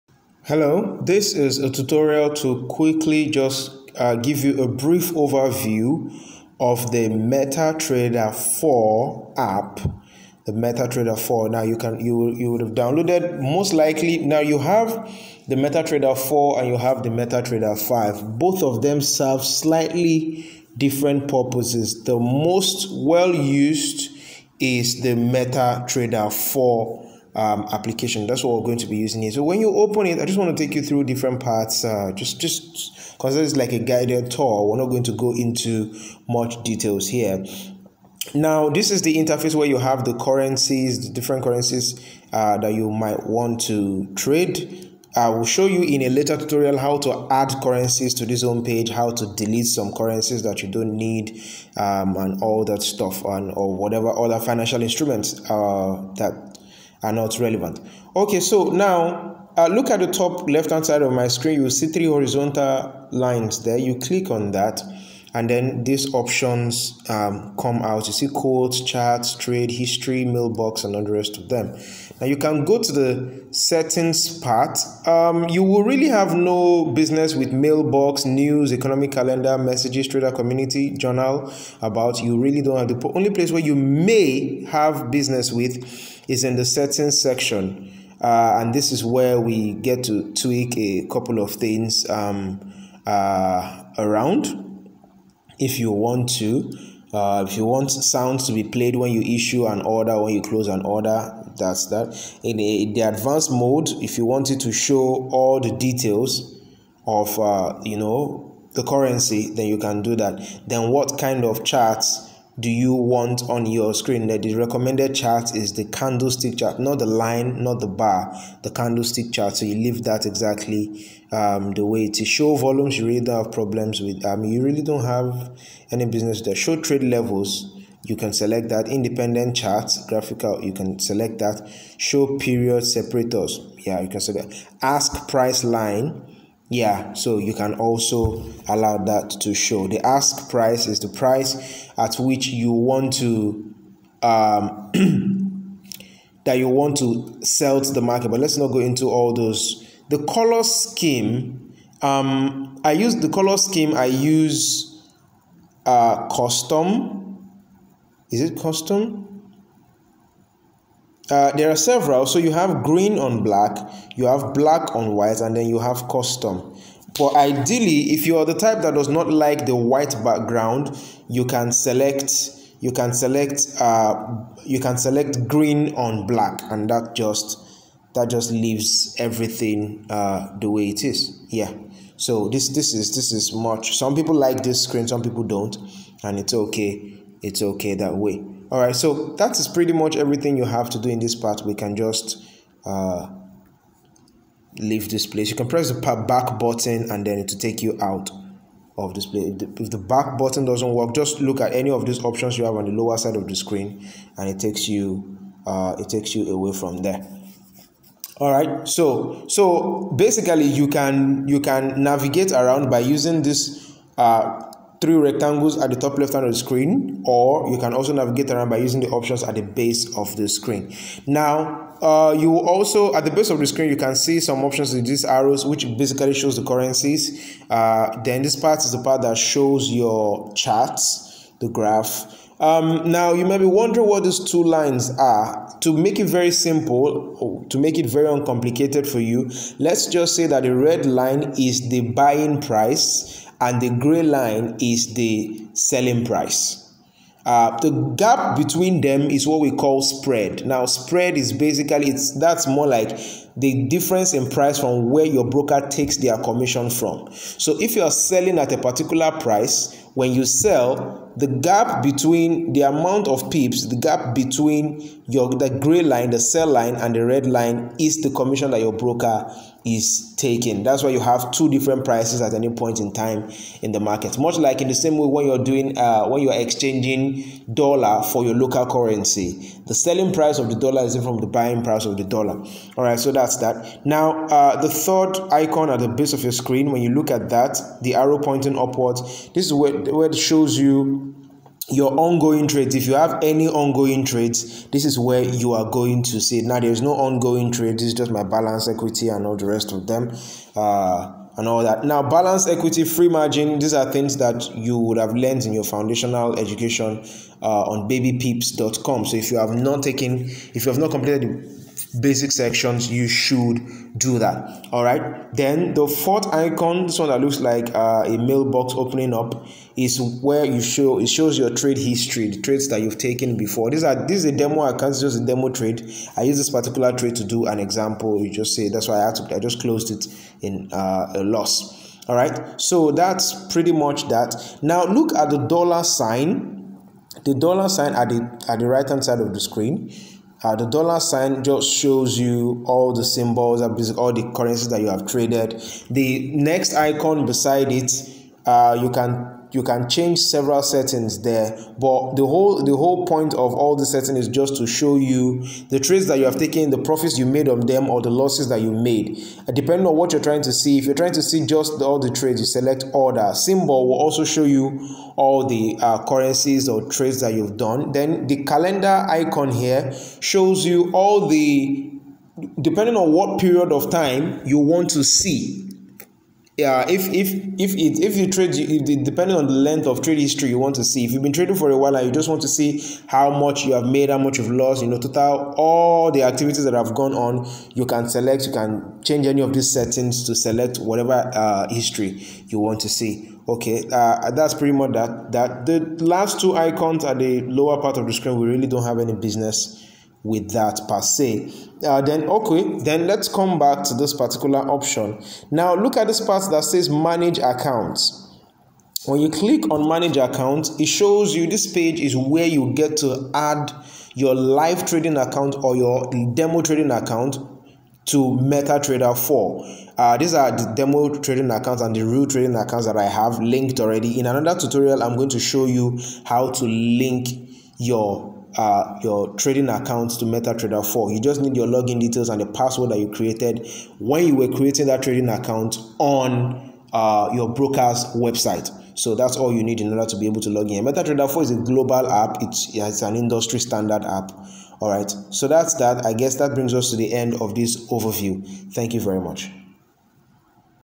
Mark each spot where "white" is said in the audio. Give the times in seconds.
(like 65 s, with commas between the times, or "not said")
165 s, 169 s.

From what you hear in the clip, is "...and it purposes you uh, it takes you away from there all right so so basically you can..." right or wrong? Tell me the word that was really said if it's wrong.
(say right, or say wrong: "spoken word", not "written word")
wrong: "takes", not "purposes".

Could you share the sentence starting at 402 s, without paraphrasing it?
Uh, then, okay, then let's come back to this particular option.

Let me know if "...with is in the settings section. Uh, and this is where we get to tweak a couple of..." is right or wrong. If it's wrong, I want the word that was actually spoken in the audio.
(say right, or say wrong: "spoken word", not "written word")
right.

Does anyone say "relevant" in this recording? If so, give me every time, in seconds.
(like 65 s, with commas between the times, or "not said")
57 s.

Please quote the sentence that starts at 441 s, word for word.
MetaTrader 4 is a global app, it's, it's an industry standard app.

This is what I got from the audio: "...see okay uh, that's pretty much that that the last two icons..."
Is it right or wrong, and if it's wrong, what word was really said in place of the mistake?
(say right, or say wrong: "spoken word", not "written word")
right.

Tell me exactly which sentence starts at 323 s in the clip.
These are this is a demo account, it's just a demo trade.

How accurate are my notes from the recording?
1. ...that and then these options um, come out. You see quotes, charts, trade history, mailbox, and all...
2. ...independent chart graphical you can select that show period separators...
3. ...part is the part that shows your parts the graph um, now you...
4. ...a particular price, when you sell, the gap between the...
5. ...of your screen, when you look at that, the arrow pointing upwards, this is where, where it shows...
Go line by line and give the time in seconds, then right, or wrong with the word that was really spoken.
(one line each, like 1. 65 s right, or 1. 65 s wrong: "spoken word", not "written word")
1. 64 s right
2. 128 s right
3. 228 s wrong: "charts", not "parts"
4. 258 s right
5. 286 s right.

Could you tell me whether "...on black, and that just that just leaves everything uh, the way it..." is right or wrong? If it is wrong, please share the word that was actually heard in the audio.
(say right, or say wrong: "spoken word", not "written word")
right.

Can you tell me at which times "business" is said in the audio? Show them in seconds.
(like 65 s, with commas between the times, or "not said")
76 s, 85 s, 126 s, 399 s.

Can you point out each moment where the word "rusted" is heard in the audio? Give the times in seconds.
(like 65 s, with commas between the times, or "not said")
not said.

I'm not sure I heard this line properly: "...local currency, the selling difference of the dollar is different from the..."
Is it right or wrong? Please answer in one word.
wrong.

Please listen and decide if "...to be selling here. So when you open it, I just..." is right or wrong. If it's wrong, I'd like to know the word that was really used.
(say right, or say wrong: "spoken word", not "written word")
wrong: "using", not "selling".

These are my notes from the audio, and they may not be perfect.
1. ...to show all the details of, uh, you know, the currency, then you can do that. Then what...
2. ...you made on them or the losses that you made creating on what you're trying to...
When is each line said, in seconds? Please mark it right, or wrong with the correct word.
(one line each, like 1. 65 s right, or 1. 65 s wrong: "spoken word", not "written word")
1. 104 s right
2. 357 s wrong: "depending", not "creating".